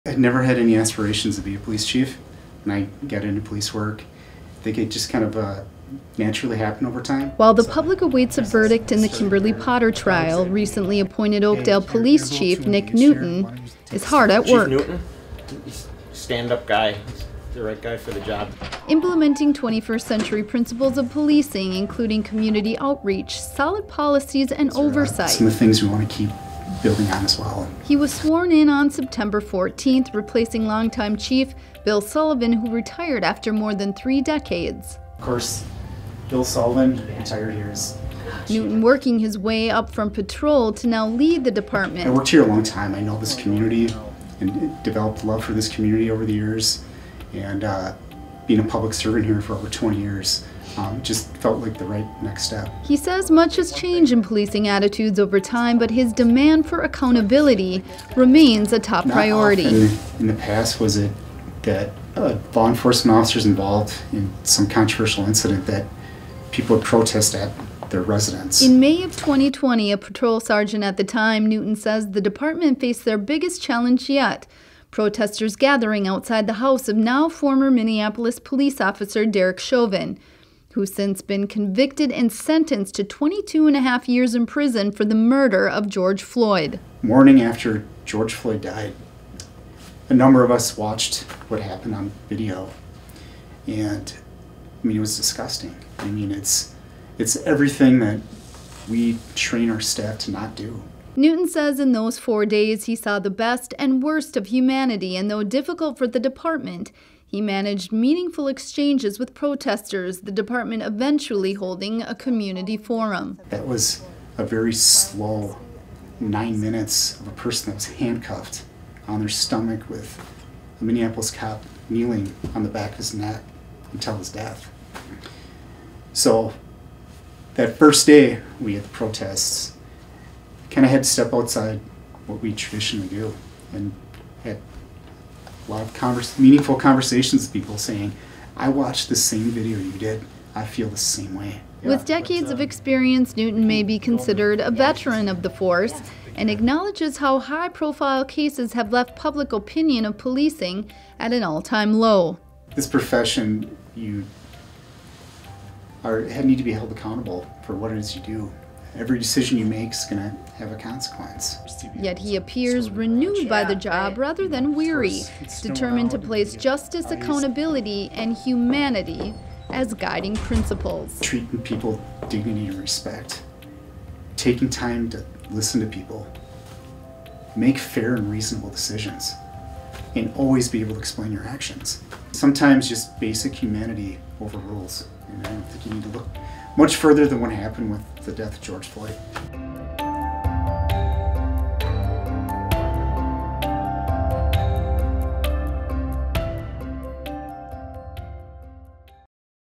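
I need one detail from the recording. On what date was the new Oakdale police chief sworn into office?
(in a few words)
September 14.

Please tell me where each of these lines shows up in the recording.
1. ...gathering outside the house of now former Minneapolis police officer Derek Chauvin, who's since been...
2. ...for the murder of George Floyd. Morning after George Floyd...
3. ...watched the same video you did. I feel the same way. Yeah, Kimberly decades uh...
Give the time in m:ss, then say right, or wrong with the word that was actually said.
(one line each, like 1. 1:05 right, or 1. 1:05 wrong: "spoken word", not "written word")
1. 1:15 right
2. 1:24 right
3. 2:18 wrong: "With", not "Kimberly".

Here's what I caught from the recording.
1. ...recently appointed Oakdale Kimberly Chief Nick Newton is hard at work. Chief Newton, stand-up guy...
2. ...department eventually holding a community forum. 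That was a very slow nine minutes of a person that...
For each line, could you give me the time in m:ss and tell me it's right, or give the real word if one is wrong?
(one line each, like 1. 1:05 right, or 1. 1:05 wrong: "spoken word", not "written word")
1. 0:10 wrong: "Police", not "Kimberly"
2. 1:50 right.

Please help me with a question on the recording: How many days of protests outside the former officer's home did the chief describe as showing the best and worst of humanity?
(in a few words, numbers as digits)
4.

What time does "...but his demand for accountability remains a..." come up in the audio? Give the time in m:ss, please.
0:55.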